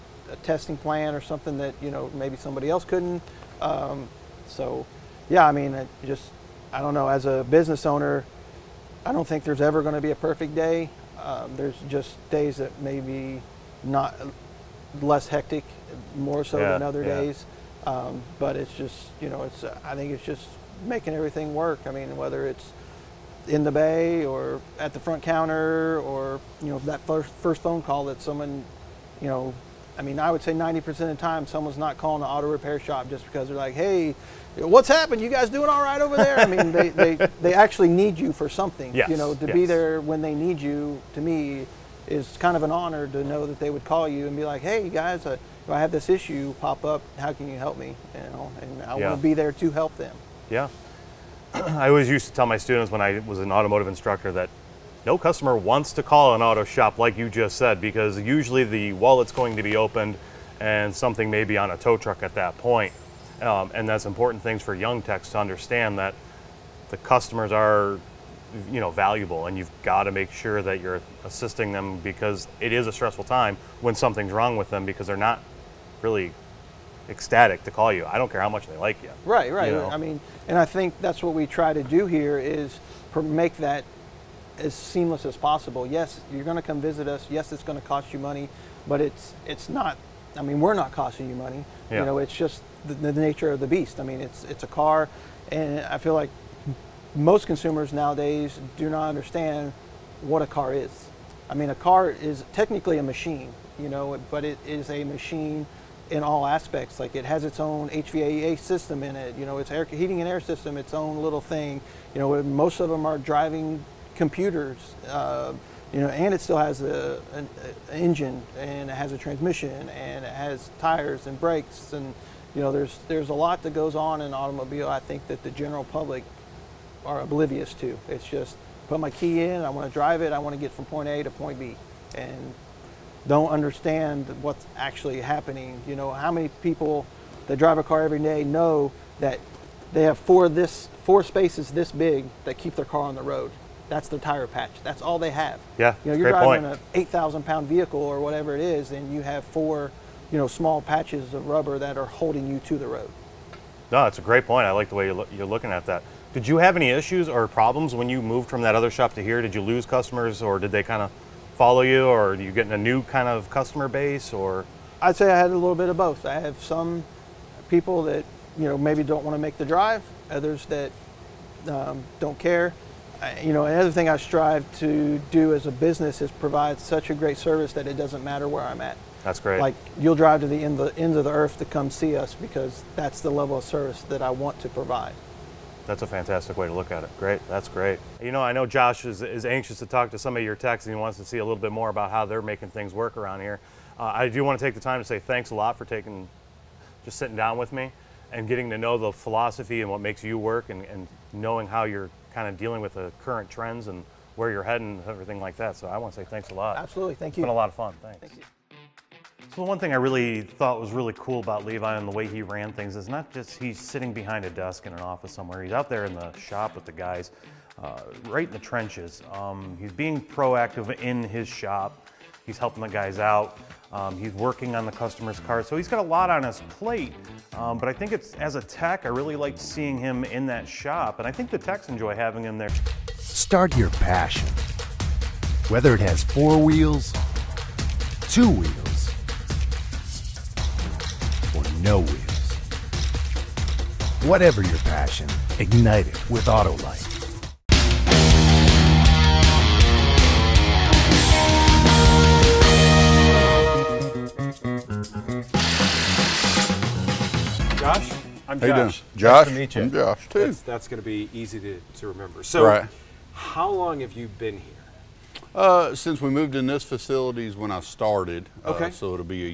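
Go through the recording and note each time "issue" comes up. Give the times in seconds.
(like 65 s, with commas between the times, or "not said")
46 s, 156 s.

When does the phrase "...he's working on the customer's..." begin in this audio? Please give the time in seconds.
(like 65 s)
224 s.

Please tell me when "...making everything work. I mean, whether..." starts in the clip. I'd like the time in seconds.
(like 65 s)
20 s.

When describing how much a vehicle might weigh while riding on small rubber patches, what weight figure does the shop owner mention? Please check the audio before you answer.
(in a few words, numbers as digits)
8,000 pounds.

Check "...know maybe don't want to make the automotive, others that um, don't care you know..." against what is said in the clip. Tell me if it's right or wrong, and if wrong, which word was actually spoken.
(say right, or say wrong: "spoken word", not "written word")
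wrong: "drive", not "automotive".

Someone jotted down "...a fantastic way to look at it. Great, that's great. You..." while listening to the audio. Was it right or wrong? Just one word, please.
right.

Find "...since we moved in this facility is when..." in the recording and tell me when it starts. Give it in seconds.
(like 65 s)
265 s.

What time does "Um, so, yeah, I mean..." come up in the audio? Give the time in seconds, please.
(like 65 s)
3 s.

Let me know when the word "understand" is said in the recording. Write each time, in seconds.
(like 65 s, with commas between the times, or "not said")
65 s, 99 s, 133 s.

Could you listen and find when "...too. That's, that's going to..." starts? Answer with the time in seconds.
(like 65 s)
260 s.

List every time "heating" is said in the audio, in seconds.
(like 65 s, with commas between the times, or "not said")
109 s.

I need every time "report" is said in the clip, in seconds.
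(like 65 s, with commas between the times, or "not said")
not said.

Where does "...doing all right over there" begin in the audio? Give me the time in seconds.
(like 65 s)
35 s.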